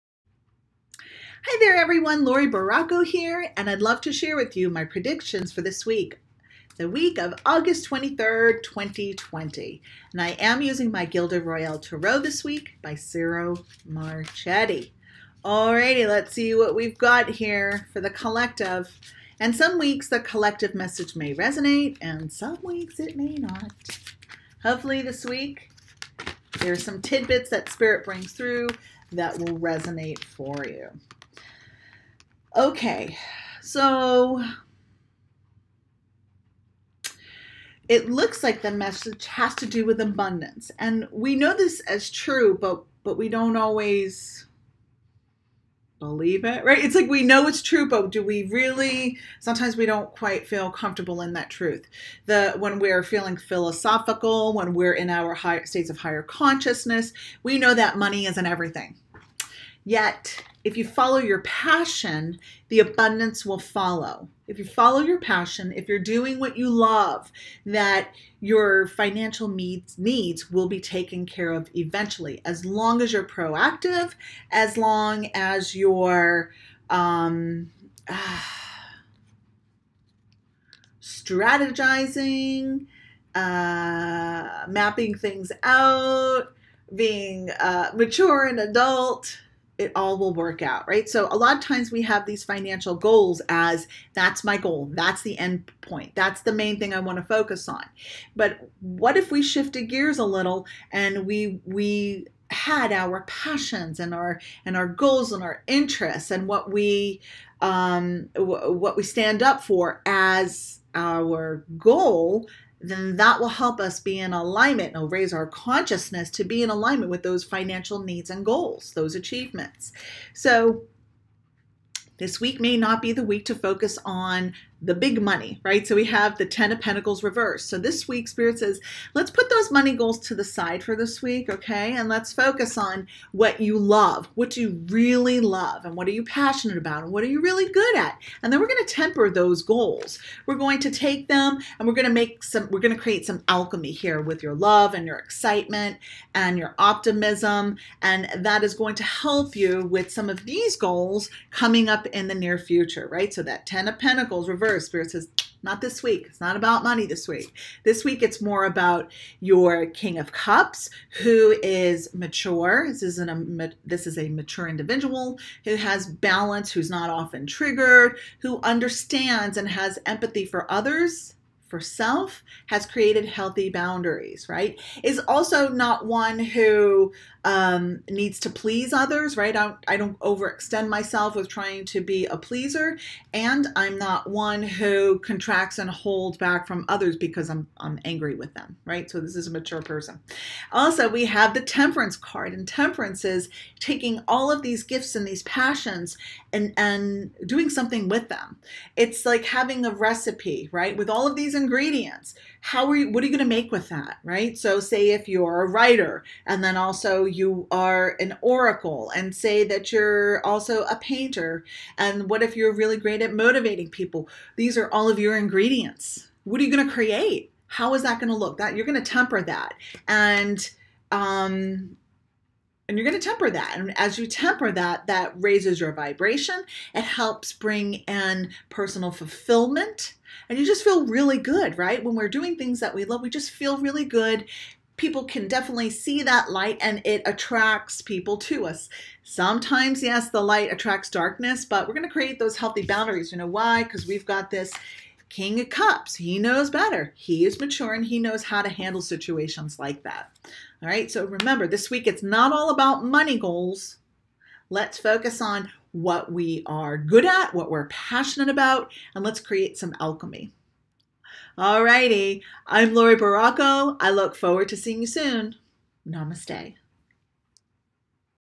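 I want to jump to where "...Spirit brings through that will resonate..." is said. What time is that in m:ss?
0:27.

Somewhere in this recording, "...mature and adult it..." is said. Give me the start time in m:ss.
1:27.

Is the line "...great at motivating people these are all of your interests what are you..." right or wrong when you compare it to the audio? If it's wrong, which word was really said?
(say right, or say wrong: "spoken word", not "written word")
wrong: "ingredients", not "interests".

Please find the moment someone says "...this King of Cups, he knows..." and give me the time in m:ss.
4:04.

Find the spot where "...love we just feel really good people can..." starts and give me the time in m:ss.
3:53.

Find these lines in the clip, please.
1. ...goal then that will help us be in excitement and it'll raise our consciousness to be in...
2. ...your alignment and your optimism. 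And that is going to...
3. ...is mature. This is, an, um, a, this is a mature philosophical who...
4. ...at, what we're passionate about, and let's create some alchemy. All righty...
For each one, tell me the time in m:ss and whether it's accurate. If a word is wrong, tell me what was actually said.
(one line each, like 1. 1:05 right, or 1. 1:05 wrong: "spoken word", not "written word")
1. 1:51 wrong: "alignment", not "excitement"
2. 2:25 wrong: "excitement", not "alignment"
3. 2:41 wrong: "individual", not "philosophical"
4. 4:17 right.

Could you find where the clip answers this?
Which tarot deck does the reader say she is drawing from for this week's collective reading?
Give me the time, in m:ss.
0:11.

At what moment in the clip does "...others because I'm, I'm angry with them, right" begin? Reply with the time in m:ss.
3:06.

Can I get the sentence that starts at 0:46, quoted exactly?
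It's like we know it's true, but do we really sometimes we don't quite feel comfortable in that truth.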